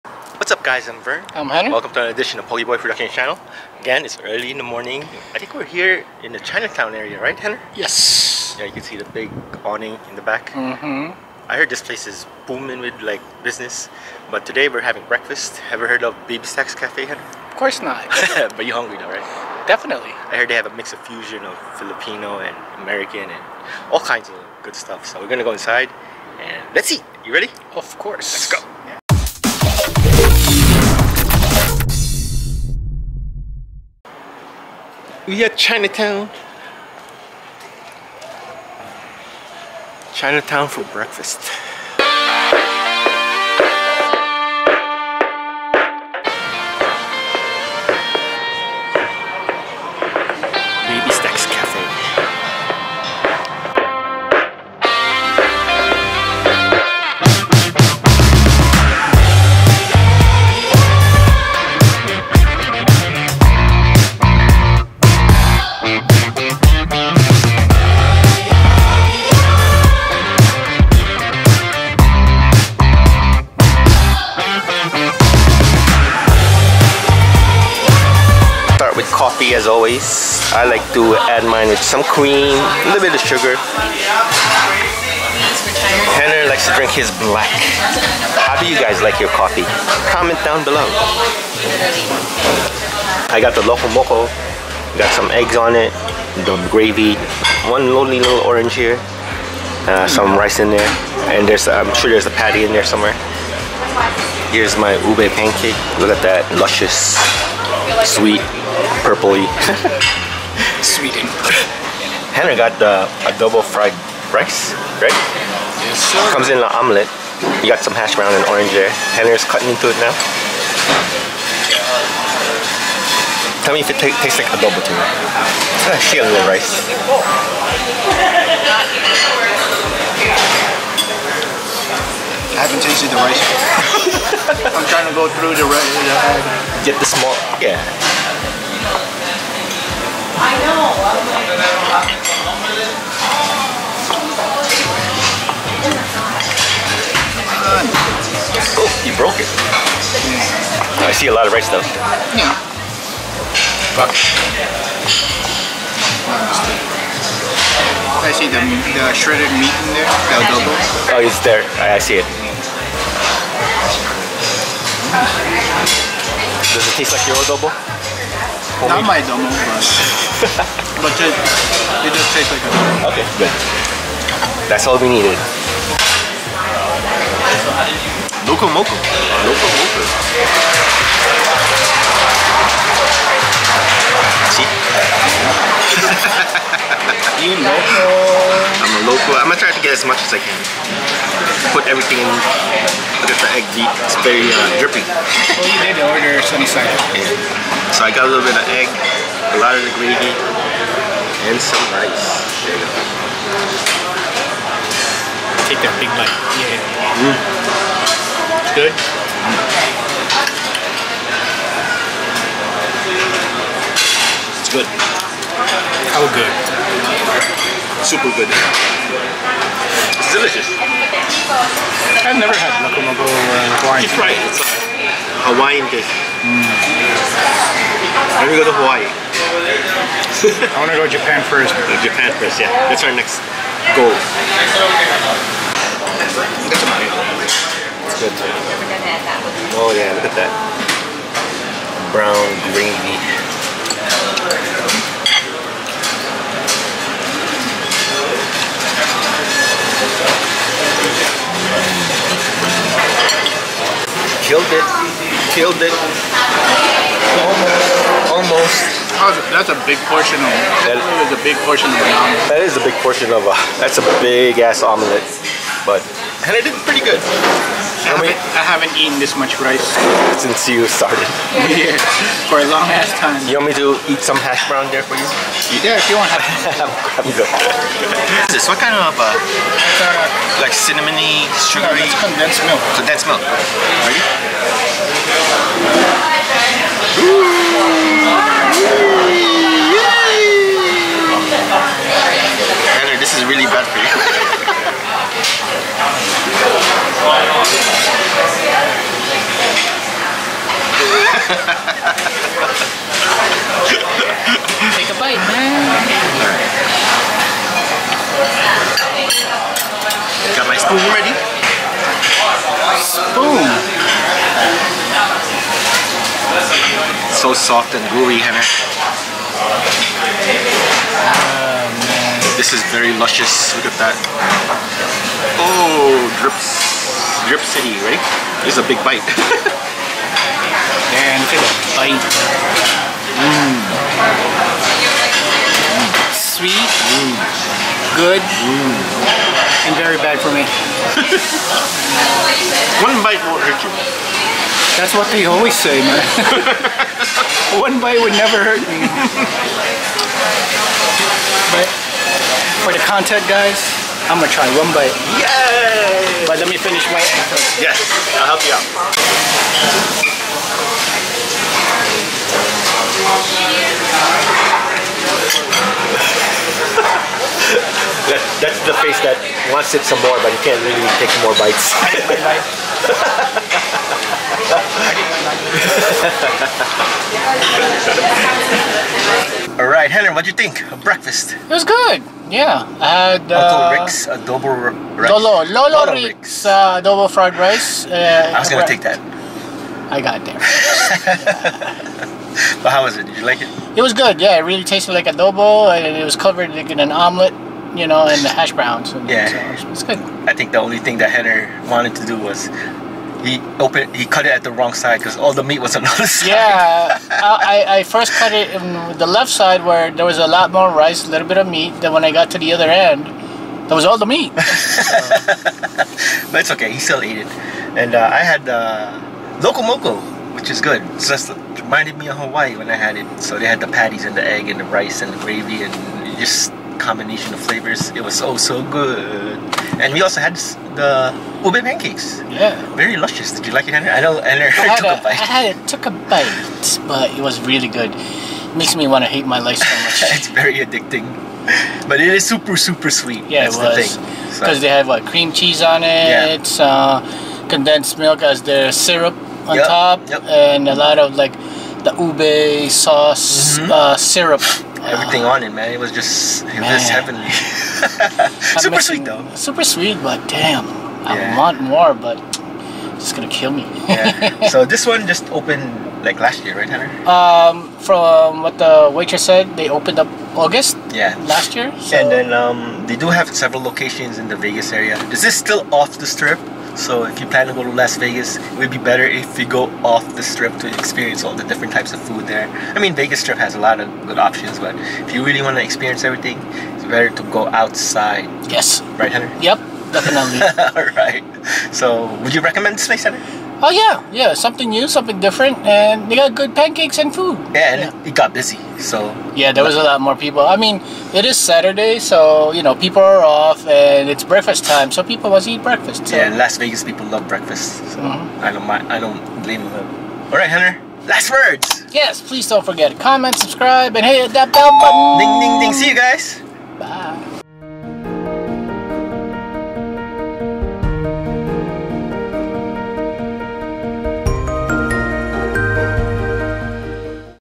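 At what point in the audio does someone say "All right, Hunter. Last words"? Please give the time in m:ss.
8:30.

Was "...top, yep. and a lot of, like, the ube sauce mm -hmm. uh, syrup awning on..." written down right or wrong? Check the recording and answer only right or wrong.
wrong.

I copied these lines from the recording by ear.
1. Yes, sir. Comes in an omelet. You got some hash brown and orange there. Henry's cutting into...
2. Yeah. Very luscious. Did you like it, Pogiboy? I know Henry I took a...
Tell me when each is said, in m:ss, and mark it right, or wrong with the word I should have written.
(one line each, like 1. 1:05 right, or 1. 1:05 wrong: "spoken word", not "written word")
1. 1:55 right
2. 7:12 wrong: "Henry", not "Pogiboy".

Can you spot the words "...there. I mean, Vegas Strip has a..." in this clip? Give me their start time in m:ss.
8:02.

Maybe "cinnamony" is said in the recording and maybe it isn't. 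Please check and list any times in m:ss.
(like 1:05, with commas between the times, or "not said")
4:40.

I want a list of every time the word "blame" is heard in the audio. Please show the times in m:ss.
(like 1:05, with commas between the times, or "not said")
8:29.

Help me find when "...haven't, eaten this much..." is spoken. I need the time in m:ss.
4:28.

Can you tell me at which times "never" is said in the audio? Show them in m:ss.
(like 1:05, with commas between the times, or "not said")
3:42, 5:48.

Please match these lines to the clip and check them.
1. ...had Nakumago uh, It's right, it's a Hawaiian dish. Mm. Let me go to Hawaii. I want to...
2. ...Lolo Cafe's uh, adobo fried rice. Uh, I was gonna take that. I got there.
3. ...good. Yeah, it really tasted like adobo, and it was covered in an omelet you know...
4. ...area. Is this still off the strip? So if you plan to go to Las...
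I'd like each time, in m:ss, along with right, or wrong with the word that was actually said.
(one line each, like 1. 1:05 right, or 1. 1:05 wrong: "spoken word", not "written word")
1. 3:42 right
2. 6:26 wrong: "Rick", not "Cafe"
3. 6:34 right
4. 7:54 right.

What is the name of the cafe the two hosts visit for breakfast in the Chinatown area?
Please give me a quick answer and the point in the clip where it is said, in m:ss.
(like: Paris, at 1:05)
BabyStacks Cafe, at 0:16.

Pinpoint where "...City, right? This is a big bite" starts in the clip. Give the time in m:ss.
5:27.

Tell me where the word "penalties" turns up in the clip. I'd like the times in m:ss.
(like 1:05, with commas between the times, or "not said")
not said.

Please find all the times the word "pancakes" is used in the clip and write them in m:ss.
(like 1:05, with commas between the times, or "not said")
1:45, 7:11, 8:16.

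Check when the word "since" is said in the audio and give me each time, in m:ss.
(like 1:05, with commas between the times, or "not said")
4:30.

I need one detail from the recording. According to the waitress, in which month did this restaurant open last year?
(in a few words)
August.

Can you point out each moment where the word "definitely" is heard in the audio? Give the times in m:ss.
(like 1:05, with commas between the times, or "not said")
0:19, 8:10.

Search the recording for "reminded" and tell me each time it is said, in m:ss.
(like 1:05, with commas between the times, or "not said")
7:01.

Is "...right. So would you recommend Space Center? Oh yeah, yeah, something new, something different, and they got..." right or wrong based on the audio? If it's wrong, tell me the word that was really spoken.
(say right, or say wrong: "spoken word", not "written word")
right.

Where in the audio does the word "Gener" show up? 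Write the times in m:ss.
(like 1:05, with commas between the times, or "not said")
1:26, 5:18, 6:41.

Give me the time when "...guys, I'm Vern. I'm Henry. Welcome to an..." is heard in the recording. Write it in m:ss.
0:00.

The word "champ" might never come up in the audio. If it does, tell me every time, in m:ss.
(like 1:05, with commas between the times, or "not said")
not said.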